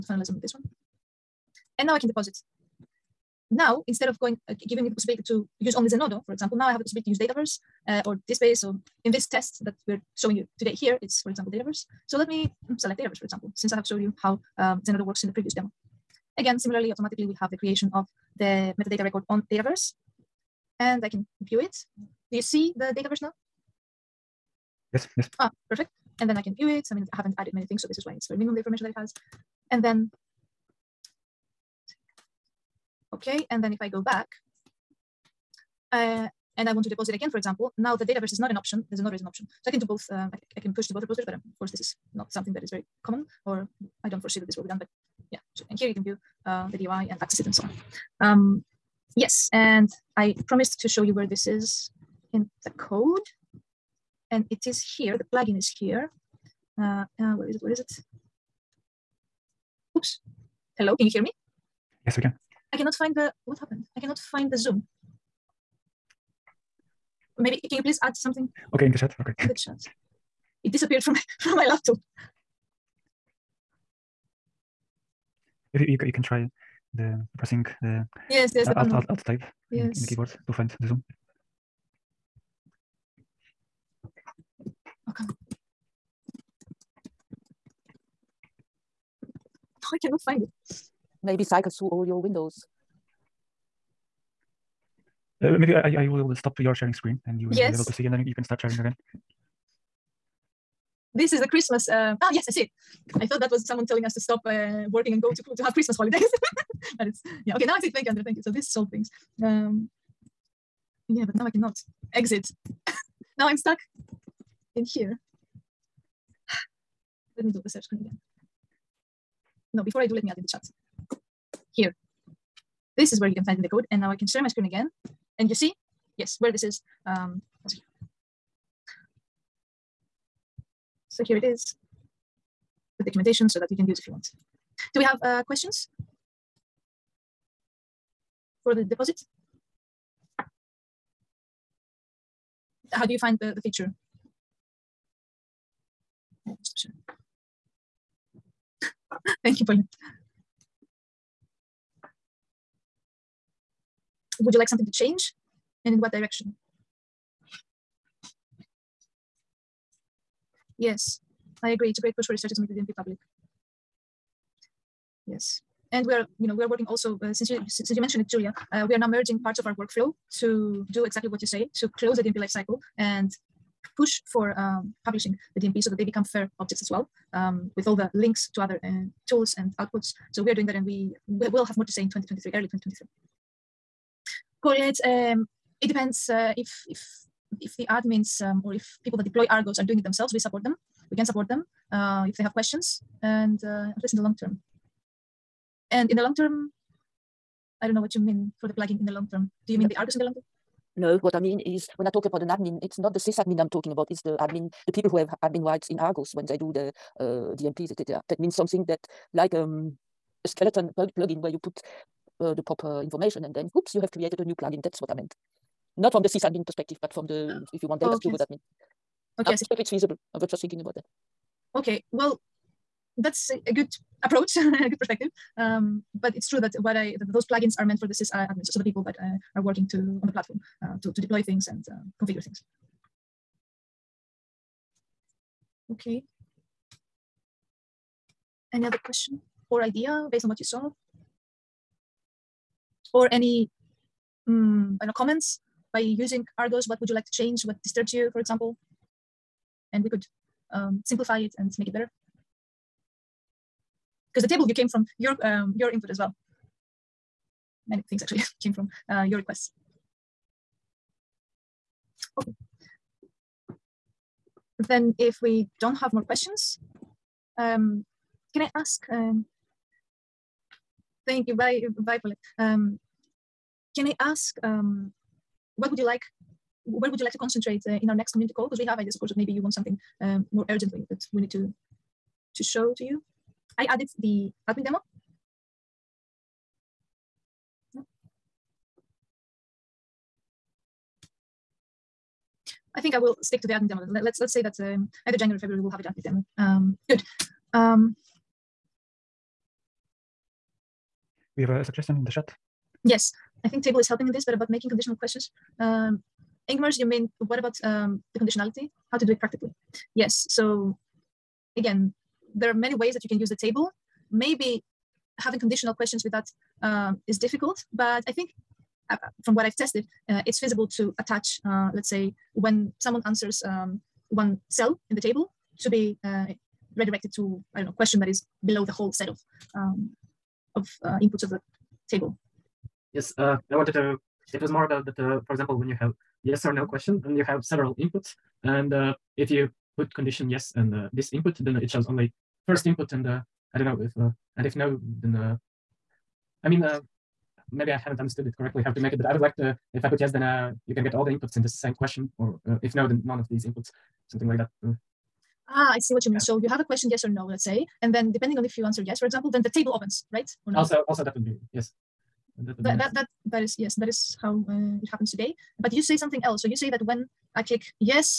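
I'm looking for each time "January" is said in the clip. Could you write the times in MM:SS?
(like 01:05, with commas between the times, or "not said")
04:55.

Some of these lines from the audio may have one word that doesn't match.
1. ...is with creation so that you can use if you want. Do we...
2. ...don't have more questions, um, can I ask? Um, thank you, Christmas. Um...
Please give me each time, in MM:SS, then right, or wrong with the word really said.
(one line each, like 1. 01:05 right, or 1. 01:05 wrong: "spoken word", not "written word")
1. 02:11 wrong: "documentation", not "creation"
2. 04:25 wrong: "Violet", not "Christmas".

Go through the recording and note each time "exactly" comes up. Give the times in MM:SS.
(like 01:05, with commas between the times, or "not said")
02:51.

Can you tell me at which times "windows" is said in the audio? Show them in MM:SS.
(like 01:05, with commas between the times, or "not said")
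01:32.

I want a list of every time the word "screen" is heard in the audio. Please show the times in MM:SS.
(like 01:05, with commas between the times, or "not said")
01:36, 01:57, 02:04.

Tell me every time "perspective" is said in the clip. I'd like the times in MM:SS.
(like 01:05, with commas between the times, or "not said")
03:36, 03:44.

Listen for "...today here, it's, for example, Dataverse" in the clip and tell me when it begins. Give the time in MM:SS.
00:10.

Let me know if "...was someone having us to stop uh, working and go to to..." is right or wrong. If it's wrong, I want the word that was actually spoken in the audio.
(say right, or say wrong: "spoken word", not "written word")
wrong: "telling", not "having".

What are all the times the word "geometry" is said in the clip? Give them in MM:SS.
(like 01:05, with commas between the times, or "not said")
not said.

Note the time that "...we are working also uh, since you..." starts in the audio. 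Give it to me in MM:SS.
02:46.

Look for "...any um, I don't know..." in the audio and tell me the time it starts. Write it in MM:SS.
04:03.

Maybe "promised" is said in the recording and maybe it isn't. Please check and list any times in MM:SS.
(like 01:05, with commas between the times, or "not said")
00:50.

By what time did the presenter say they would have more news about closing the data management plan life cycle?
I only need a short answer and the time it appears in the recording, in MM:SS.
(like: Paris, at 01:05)
early 2023, at 03:02.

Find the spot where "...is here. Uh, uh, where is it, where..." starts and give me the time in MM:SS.
00:55.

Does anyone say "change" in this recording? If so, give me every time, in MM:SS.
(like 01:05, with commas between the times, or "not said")
02:34, 04:07.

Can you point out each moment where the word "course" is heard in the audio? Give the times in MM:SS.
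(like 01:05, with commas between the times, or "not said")
00:41, 04:39.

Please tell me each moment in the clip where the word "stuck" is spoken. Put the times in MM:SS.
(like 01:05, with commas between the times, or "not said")
01:53.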